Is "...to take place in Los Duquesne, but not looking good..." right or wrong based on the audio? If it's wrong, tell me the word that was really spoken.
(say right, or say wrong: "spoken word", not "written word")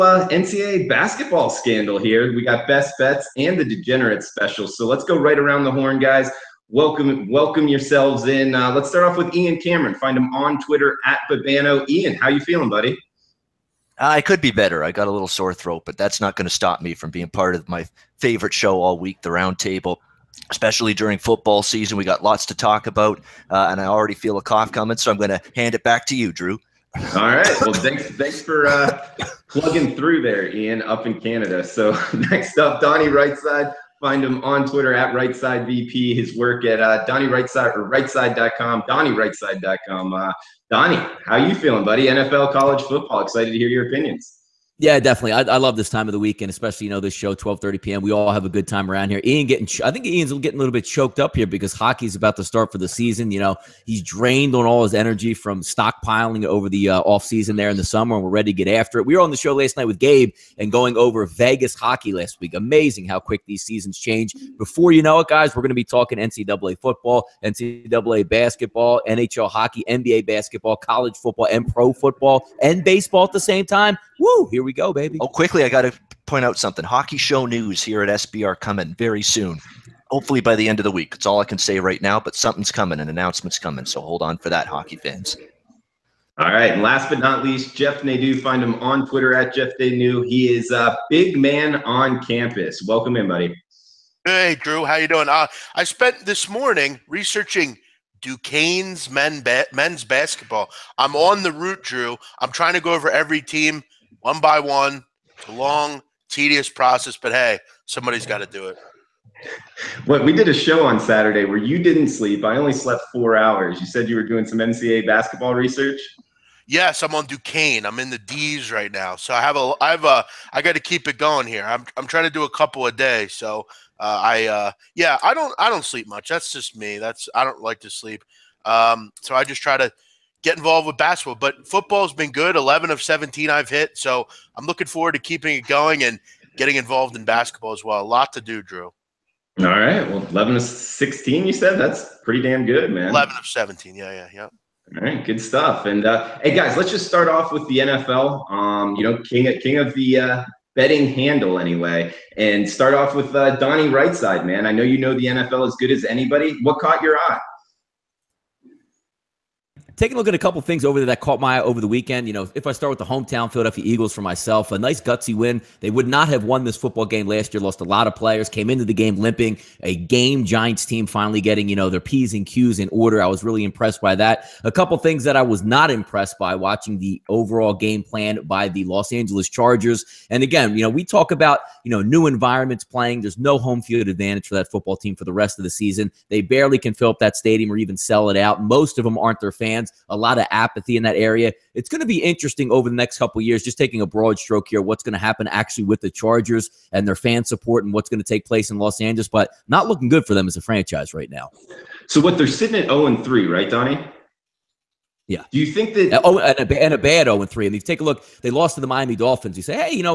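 wrong: "Angeles", not "Duquesne".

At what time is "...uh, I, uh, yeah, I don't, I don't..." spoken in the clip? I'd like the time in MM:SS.
02:03.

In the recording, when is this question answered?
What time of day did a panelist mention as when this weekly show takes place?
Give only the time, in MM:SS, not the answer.
00:47.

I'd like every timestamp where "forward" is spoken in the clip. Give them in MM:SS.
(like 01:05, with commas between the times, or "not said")
02:14.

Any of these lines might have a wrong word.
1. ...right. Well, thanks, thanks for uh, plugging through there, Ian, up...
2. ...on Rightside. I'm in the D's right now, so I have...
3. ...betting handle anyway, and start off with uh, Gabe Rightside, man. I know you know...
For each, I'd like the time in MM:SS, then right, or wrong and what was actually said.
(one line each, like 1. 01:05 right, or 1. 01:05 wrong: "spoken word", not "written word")
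1. 00:27 right
2. 01:57 wrong: "Duquesne", not "Rightside"
3. 02:30 wrong: "Donnie", not "Gabe".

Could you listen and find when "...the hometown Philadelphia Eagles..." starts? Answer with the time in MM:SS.
02:42.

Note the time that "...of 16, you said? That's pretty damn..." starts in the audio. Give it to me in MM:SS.
02:20.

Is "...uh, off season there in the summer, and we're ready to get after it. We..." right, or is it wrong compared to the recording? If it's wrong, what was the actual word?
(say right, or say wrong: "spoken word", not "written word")
right.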